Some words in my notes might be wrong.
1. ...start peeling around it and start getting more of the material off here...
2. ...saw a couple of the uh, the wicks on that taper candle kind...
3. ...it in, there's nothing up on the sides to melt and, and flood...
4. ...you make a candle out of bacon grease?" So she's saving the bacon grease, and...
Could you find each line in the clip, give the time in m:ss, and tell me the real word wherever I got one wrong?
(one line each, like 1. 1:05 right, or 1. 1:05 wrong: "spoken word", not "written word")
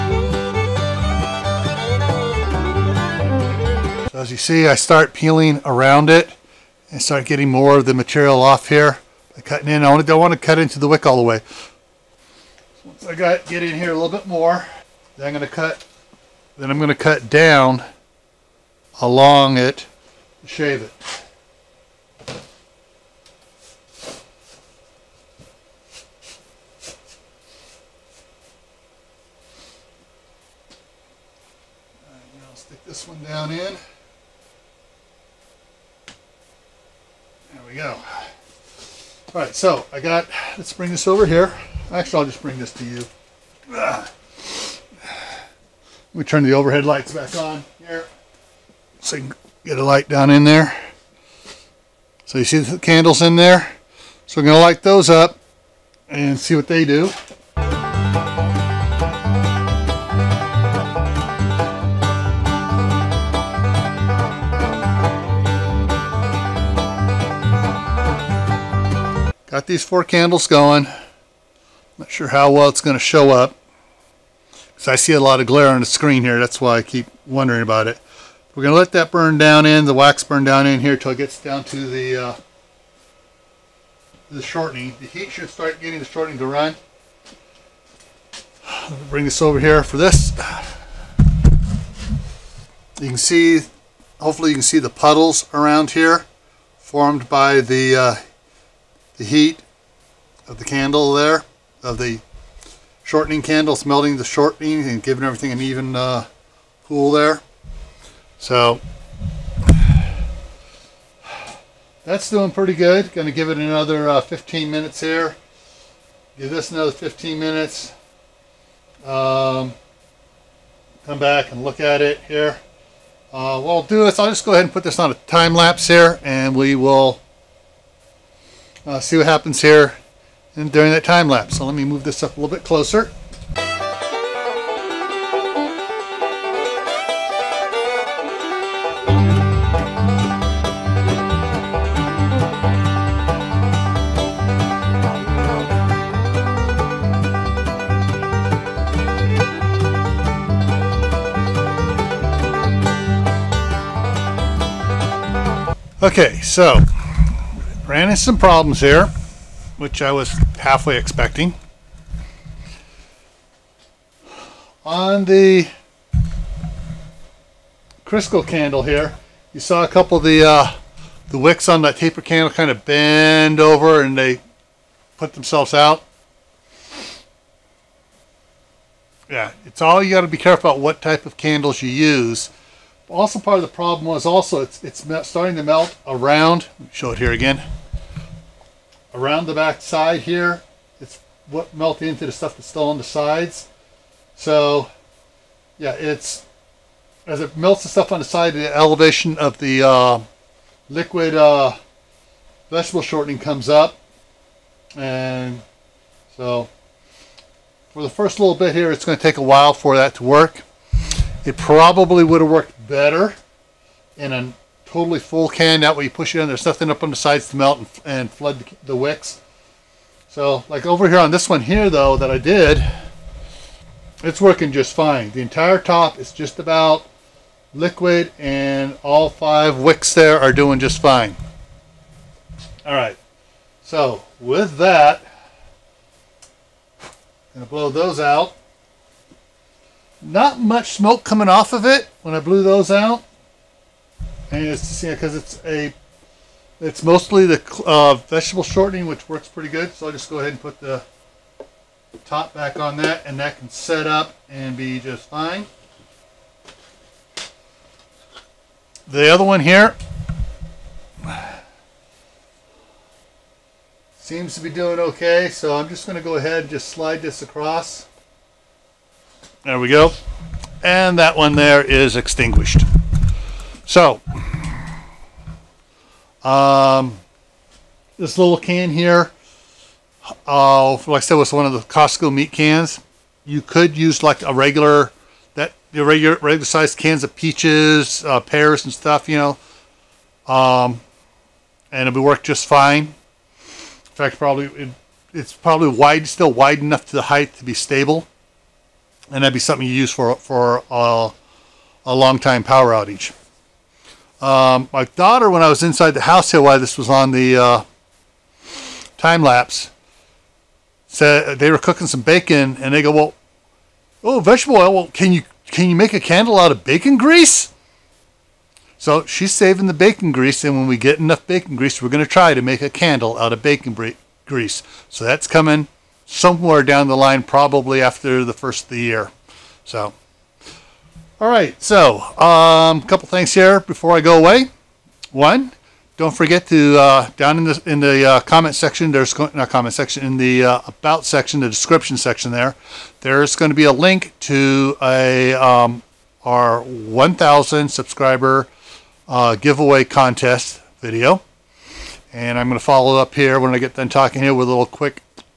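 1. 0:04 right
2. 2:49 right
3. 3:36 right
4. 5:15 right.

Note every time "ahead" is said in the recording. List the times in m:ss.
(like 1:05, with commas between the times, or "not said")
2:04, 4:10, 4:26.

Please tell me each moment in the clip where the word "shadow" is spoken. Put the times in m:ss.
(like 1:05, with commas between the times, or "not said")
not said.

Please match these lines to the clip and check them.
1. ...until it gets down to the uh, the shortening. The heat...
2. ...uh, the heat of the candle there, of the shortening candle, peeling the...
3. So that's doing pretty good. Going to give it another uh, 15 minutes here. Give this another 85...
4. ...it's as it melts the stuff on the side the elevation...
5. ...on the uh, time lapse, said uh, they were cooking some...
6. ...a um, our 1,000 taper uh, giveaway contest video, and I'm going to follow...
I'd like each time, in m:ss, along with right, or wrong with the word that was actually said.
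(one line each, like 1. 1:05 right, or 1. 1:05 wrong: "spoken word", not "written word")
1. 1:20 right
2. 1:37 wrong: "smelting", not "peeling"
3. 1:48 wrong: "15", not "85"
4. 3:15 right
5. 5:07 right
6. 5:45 wrong: "subscriber", not "taper".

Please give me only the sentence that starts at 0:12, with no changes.
Once I got get in here a little bit more, then I'm going to cut.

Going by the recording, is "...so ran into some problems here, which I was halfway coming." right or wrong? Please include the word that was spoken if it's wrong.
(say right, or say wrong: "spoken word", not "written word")
wrong: "expecting", not "coming".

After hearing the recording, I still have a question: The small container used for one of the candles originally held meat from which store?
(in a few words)
Costco.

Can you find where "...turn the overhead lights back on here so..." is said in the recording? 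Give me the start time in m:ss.
0:46.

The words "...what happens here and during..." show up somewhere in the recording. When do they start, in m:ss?
2:09.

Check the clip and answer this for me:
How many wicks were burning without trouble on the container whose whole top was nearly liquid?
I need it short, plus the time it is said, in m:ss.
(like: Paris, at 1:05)
5, at 3:49.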